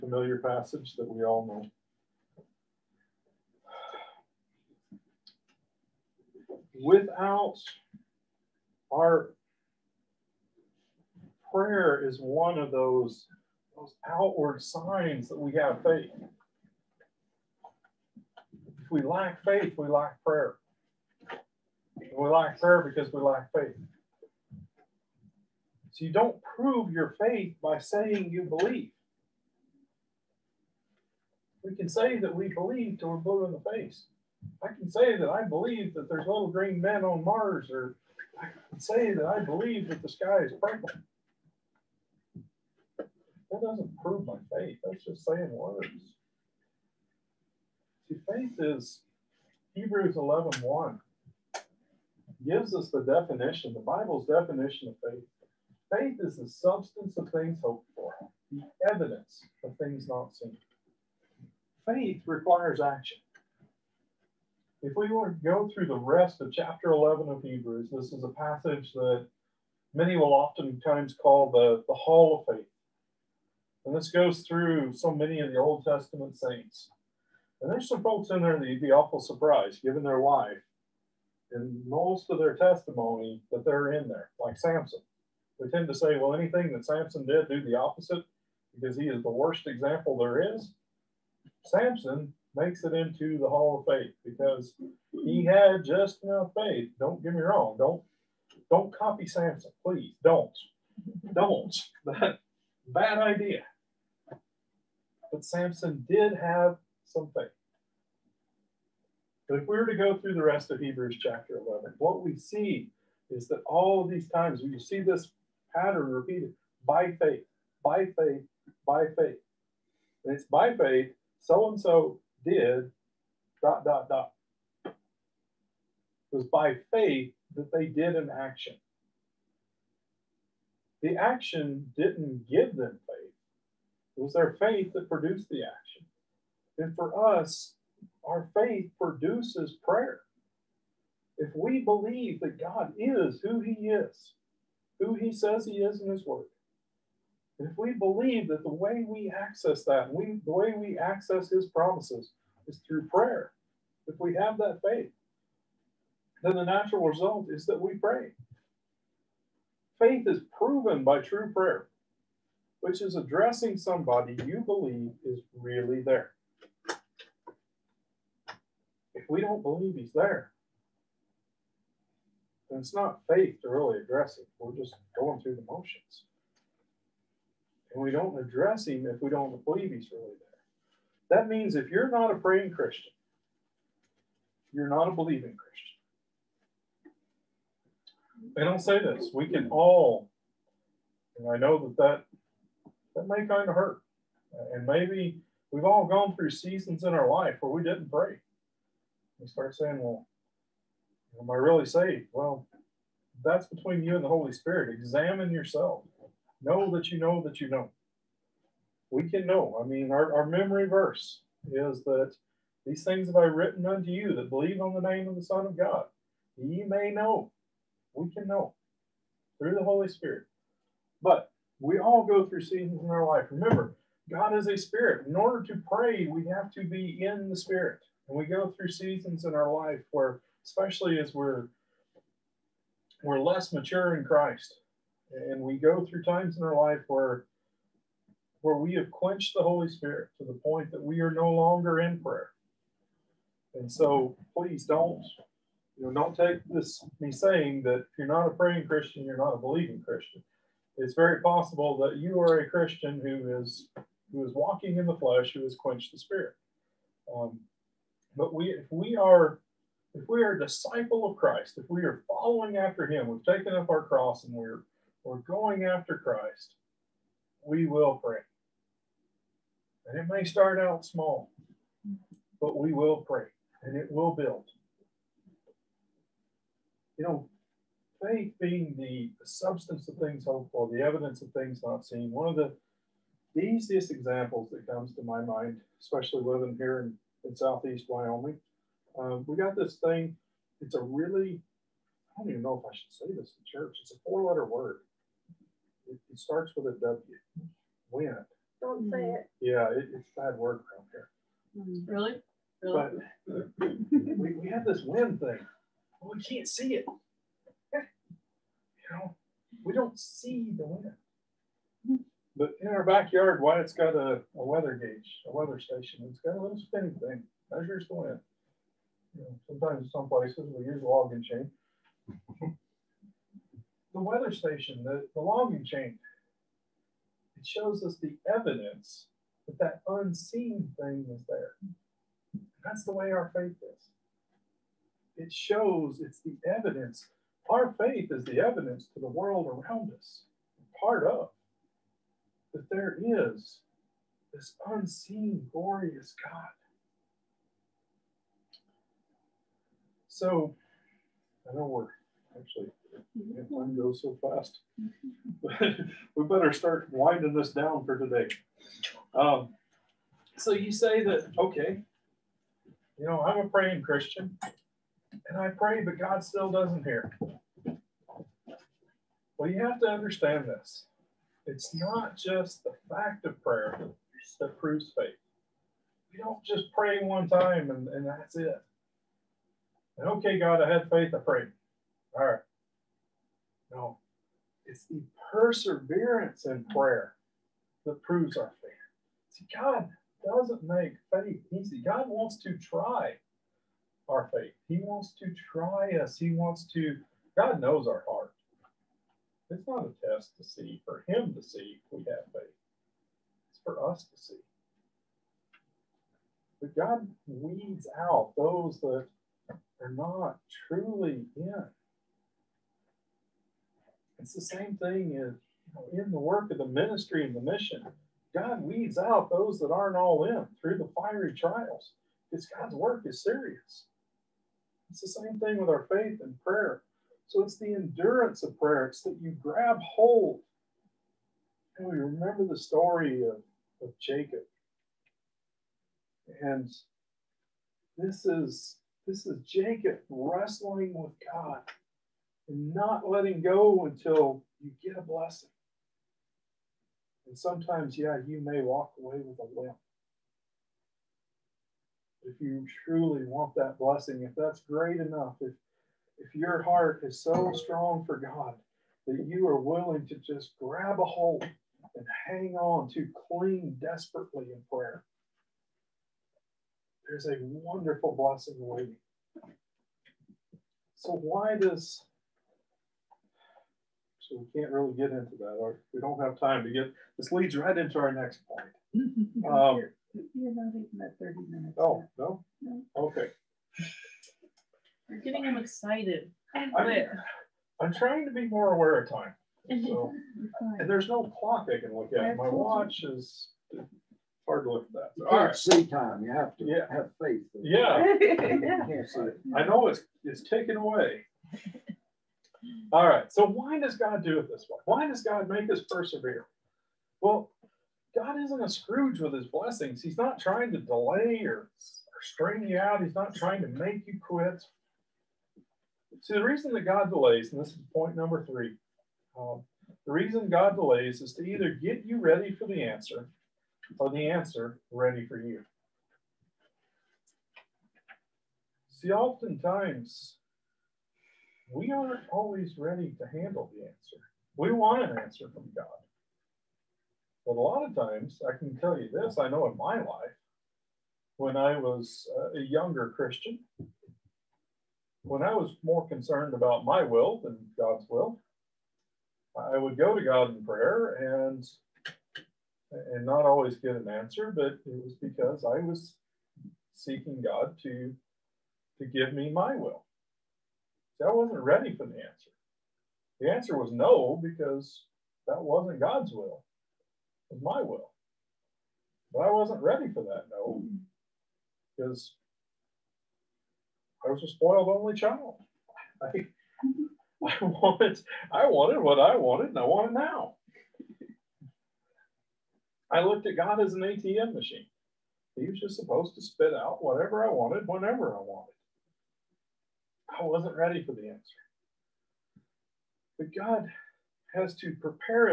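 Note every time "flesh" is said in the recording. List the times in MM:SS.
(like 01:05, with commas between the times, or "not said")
04:15.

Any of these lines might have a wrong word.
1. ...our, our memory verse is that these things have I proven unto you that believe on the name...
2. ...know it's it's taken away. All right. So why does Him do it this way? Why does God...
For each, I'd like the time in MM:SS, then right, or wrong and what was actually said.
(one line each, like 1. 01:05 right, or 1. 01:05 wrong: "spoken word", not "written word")
1. 03:30 wrong: "written", not "proven"
2. 08:19 wrong: "God", not "Him".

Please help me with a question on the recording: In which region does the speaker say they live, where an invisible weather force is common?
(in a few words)
southeast Wyoming.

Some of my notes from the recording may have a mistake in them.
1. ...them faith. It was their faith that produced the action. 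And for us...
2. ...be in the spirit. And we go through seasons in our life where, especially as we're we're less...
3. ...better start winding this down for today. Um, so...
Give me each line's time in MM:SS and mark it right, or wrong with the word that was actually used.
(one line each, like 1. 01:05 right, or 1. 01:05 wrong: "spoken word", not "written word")
1. 02:12 right
2. 03:46 right
3. 05:56 right.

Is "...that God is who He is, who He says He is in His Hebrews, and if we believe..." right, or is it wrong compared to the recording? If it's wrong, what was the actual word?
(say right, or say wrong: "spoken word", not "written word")
wrong: "Word", not "Hebrews".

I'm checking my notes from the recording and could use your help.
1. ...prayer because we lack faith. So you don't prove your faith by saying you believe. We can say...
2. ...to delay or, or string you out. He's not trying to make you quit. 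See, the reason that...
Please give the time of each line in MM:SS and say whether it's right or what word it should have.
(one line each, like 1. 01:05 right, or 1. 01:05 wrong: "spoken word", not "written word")
1. 00:22 right
2. 08:30 right.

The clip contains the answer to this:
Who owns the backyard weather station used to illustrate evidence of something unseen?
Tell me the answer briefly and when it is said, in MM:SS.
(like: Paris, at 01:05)
Wyatt, at 05:13.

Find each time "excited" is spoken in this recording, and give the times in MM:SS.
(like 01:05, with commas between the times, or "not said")
08:05.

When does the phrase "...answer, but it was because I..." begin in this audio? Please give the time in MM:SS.
09:14.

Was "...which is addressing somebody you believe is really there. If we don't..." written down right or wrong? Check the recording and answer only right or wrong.
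right.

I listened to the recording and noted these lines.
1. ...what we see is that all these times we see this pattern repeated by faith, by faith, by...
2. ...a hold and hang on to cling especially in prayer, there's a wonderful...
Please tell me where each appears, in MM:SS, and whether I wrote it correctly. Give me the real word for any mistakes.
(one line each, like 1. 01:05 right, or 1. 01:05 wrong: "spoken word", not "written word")
1. 01:51 right
2. 07:41 wrong: "desperately", not "especially".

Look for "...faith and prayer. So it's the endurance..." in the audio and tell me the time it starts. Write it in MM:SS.
07:06.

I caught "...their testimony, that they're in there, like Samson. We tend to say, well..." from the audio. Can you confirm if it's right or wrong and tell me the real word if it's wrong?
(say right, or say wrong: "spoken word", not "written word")
right.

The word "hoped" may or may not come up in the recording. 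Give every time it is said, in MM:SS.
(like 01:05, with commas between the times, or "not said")
00:57, 04:40.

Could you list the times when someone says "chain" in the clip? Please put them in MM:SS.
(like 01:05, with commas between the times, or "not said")
05:21, 05:25.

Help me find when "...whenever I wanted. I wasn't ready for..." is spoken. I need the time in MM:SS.
09:48.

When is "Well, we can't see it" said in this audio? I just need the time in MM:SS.
05:06.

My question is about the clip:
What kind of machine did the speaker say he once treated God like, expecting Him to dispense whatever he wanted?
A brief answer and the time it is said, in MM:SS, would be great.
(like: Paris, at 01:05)
ATM machine, at 09:44.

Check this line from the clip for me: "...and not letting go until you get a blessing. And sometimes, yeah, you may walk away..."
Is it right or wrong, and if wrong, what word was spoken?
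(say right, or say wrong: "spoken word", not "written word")
right.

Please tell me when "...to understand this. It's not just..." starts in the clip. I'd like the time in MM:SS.
06:10.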